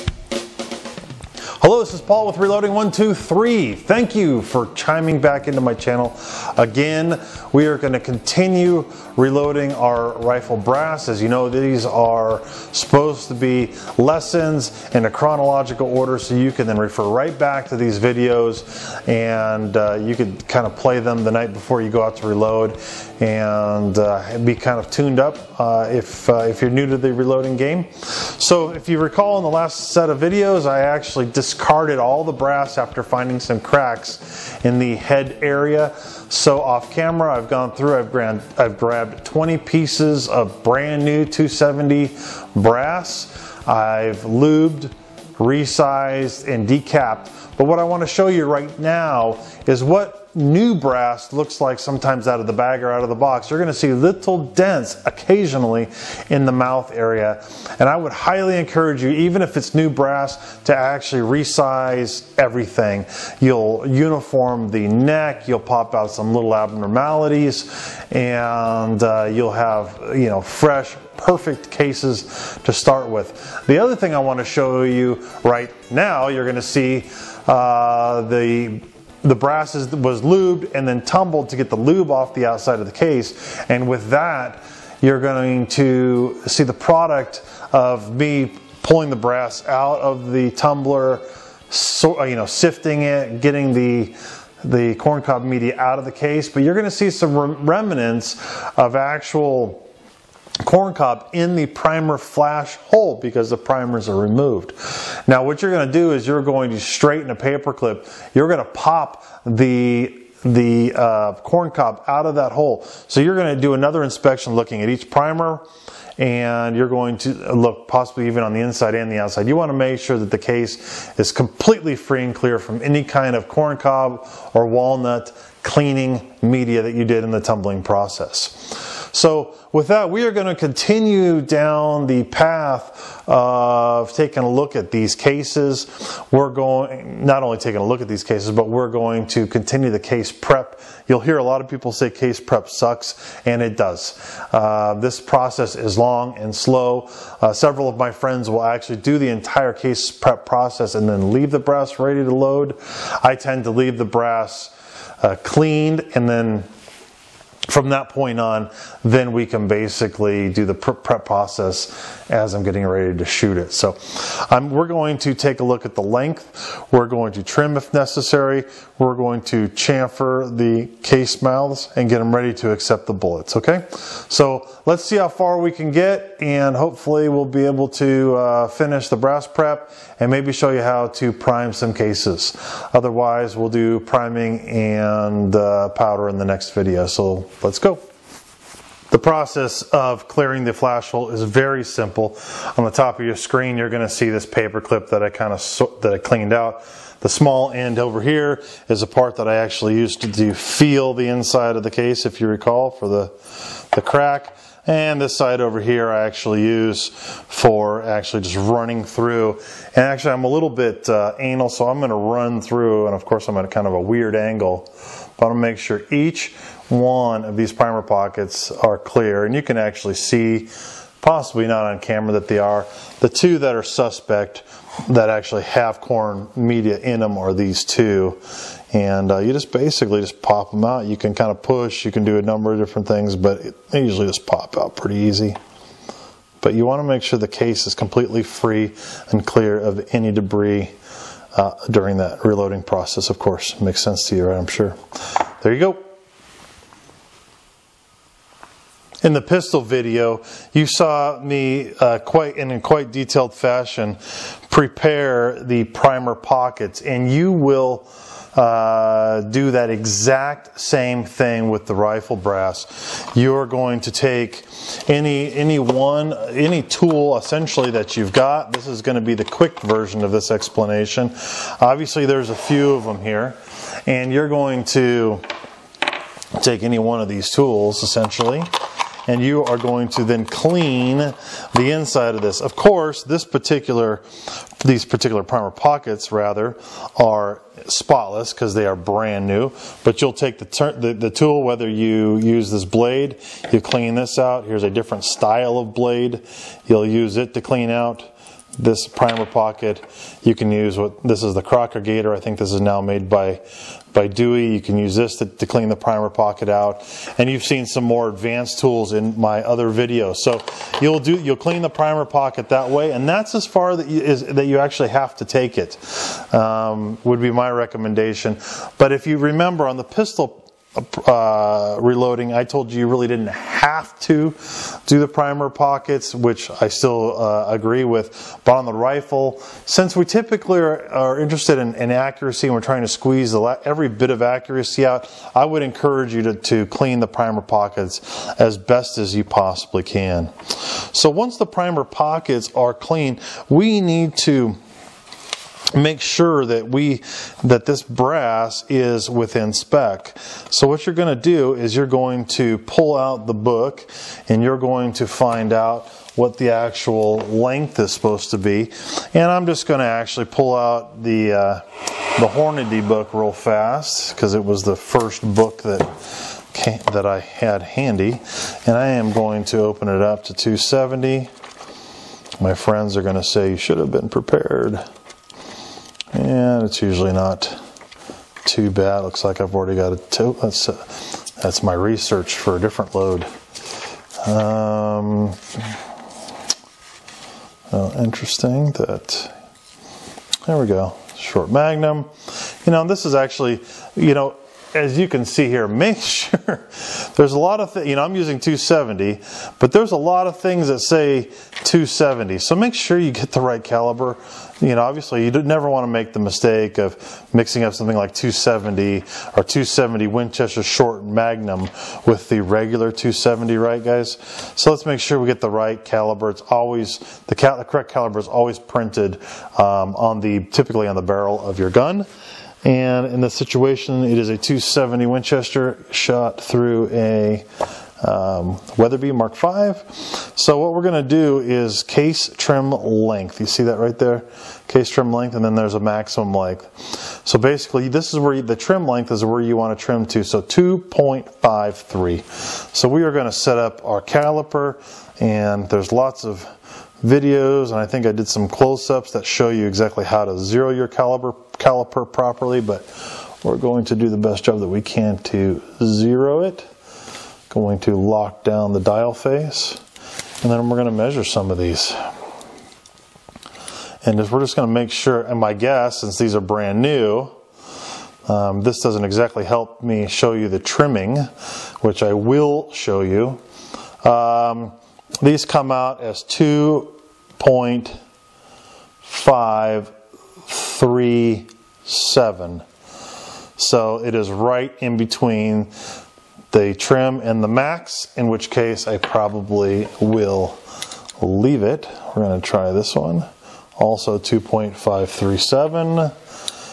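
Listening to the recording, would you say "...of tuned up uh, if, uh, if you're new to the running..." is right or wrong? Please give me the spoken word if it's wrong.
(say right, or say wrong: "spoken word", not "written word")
wrong: "reloading", not "running".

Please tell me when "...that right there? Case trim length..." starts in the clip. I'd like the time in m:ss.
7:13.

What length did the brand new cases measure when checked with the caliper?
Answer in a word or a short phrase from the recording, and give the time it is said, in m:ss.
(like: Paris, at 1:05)
2.537, at 7:56.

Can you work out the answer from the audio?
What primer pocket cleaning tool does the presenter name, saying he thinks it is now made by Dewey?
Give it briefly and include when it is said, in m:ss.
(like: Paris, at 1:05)
Crocogator, at 5:01.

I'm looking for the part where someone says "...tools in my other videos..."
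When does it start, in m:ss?
5:08.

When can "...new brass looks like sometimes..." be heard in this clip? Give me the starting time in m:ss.
0:50.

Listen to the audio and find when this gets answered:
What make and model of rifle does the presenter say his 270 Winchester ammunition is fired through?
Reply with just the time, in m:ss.
7:08.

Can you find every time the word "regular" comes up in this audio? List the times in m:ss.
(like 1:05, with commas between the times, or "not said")
6:52.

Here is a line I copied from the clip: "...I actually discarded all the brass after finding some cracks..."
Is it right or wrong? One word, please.
right.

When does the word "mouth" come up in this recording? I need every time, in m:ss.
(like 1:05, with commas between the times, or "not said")
0:56, 2:51.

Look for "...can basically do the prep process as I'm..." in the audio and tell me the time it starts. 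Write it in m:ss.
2:39.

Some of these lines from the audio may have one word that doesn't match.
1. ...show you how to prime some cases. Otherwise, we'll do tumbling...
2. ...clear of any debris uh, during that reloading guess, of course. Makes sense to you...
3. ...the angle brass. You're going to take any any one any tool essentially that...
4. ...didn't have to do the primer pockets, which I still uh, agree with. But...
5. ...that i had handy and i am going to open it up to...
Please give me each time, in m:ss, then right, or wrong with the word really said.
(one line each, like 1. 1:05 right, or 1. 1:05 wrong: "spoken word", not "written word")
1. 3:00 wrong: "priming", not "tumbling"
2. 3:59 wrong: "process", not "guess"
3. 4:21 wrong: "rifle", not "angle"
4. 5:23 right
5. 6:07 right.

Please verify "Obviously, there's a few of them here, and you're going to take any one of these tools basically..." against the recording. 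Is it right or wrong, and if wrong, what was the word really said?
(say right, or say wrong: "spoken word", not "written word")
wrong: "essentially", not "basically".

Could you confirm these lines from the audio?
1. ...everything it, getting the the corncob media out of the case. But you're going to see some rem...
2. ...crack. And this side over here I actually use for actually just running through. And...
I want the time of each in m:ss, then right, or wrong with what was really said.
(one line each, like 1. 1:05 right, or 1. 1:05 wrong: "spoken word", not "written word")
1. 1:32 wrong: "sifting", not "everything"
2. 3:24 right.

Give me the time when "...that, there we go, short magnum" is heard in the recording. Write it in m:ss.
6:28.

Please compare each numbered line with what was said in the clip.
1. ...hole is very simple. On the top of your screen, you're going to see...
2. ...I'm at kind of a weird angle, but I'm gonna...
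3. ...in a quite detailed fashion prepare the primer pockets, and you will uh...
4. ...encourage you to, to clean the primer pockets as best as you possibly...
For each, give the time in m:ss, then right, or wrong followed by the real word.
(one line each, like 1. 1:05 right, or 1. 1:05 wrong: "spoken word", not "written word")
1. 3:11 right
2. 3:33 right
3. 4:12 right
4. 5:35 right.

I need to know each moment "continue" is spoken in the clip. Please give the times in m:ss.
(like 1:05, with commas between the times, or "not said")
0:08, 2:10, 2:19.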